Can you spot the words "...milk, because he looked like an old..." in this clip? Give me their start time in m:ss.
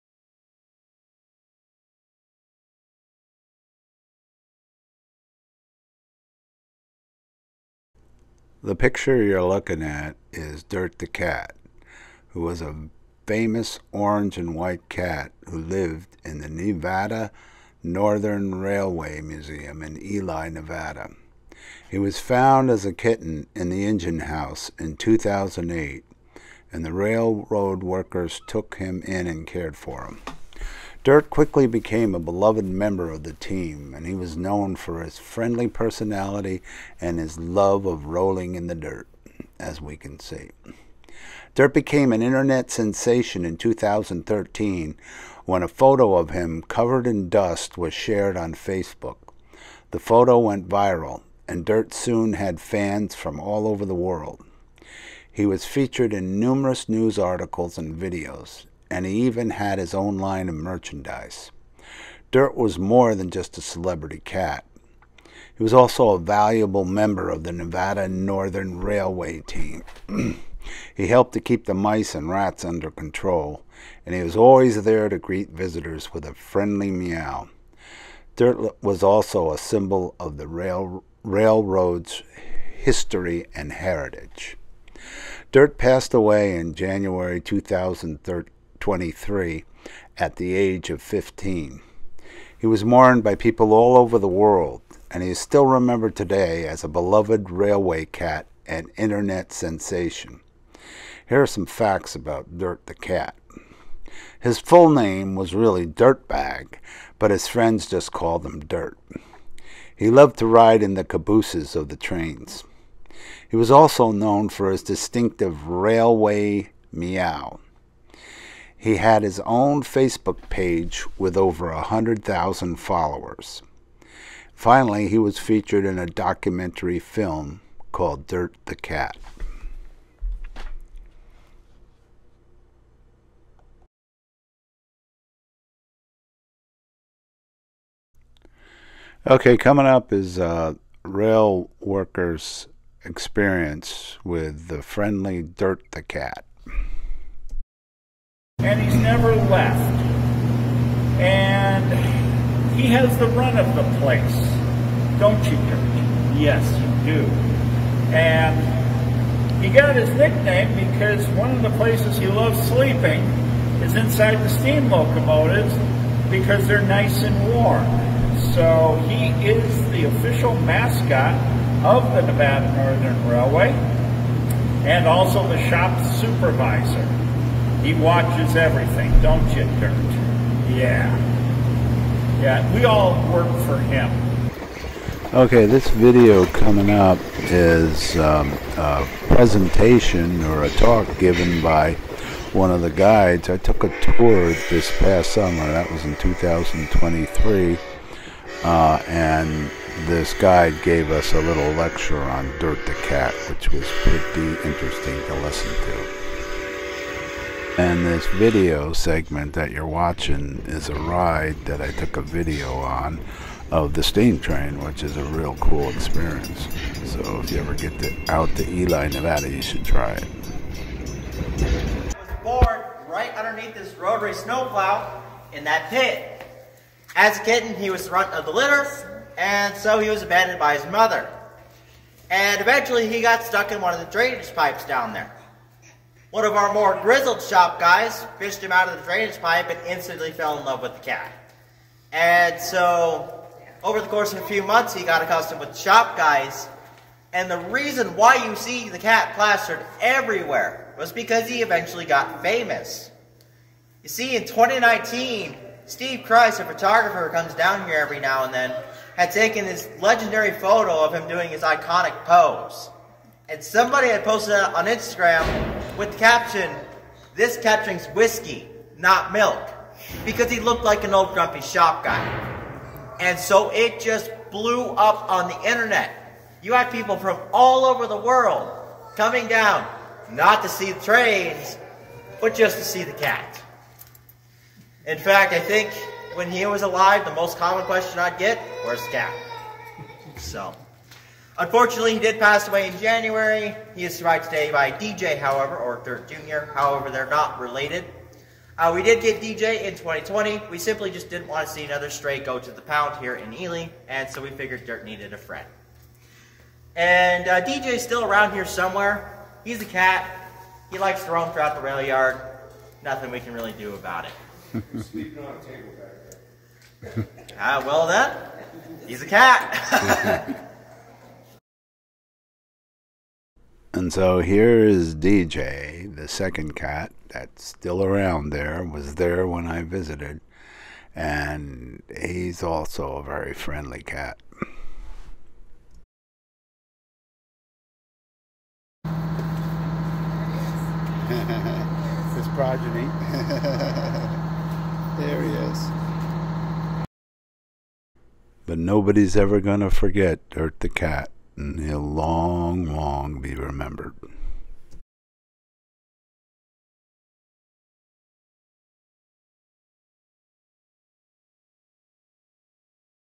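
4:29.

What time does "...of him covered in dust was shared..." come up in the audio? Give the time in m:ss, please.
0:46.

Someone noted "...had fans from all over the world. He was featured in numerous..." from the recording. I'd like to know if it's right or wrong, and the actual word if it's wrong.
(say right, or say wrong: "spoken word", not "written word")
right.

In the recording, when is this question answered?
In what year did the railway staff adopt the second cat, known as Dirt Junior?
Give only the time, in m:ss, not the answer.
4:59.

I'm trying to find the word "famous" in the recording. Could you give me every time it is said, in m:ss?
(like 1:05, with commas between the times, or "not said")
0:13, 4:12.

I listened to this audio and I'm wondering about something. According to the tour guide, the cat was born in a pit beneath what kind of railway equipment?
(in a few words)
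rotary snowplow.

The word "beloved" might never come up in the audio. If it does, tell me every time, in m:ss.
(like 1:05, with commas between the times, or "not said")
0:32, 1:36.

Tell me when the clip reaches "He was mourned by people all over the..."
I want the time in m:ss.
1:32.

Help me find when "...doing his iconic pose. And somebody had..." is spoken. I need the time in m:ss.
4:21.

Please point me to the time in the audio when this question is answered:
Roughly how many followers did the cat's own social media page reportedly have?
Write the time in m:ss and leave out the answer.
2:01.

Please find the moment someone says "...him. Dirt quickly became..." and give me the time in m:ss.
0:30.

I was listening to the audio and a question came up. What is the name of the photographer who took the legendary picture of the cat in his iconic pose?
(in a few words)
Steve Christ.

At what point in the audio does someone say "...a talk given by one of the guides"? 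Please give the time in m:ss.
3:10.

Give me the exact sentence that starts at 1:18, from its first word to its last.
Dirt was also a symbol of the rail, railroad's history and heritage.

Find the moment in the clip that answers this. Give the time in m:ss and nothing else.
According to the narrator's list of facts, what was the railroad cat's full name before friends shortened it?
1:45.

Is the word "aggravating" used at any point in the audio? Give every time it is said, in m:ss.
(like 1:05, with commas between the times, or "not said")
not said.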